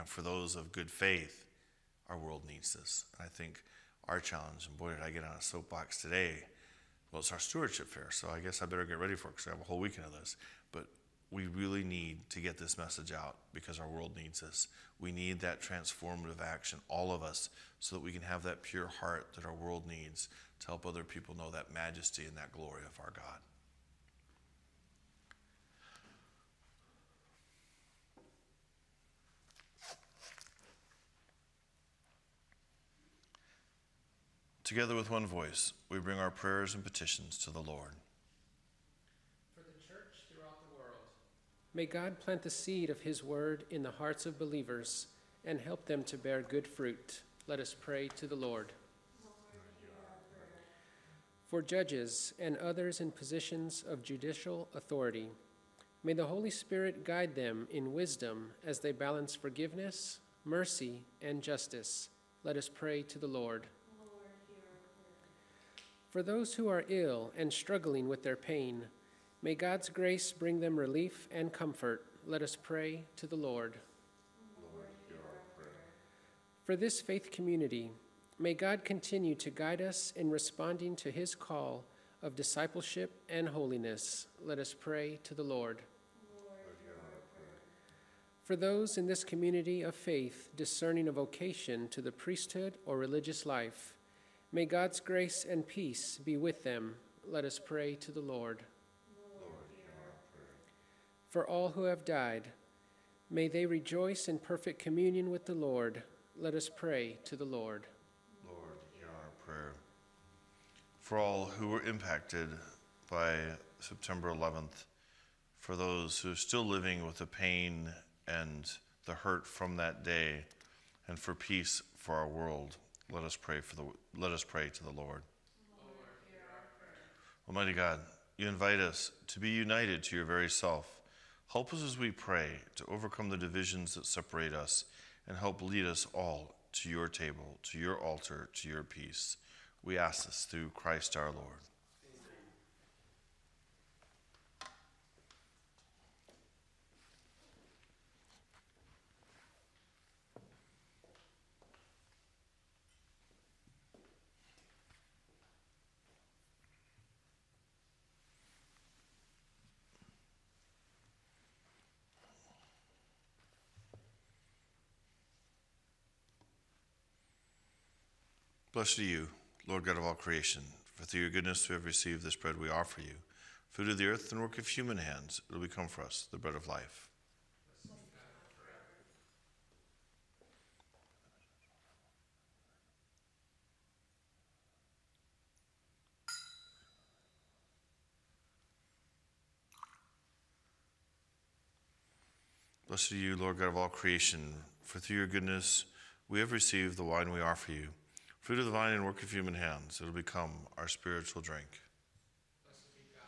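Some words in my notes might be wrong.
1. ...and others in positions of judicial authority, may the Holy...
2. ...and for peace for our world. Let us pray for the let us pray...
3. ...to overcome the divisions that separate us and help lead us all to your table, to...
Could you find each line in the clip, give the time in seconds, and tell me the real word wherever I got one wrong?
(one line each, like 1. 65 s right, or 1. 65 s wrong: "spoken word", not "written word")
1. 52 s right
2. 121 s right
3. 132 s right.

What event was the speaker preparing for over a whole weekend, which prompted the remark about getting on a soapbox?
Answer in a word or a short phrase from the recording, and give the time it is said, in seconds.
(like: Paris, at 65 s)
Stewardship fair, at 7 s.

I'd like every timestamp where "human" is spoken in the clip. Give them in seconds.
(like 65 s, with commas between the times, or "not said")
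174 s, 199 s.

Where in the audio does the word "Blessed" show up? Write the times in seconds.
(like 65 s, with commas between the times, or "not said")
168 s, 192 s.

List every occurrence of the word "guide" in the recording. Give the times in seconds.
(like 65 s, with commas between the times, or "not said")
57 s, 79 s.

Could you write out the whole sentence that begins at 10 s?
But we really need to get this message out because our world needs us.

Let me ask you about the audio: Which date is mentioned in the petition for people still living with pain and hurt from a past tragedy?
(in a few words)
September 11th.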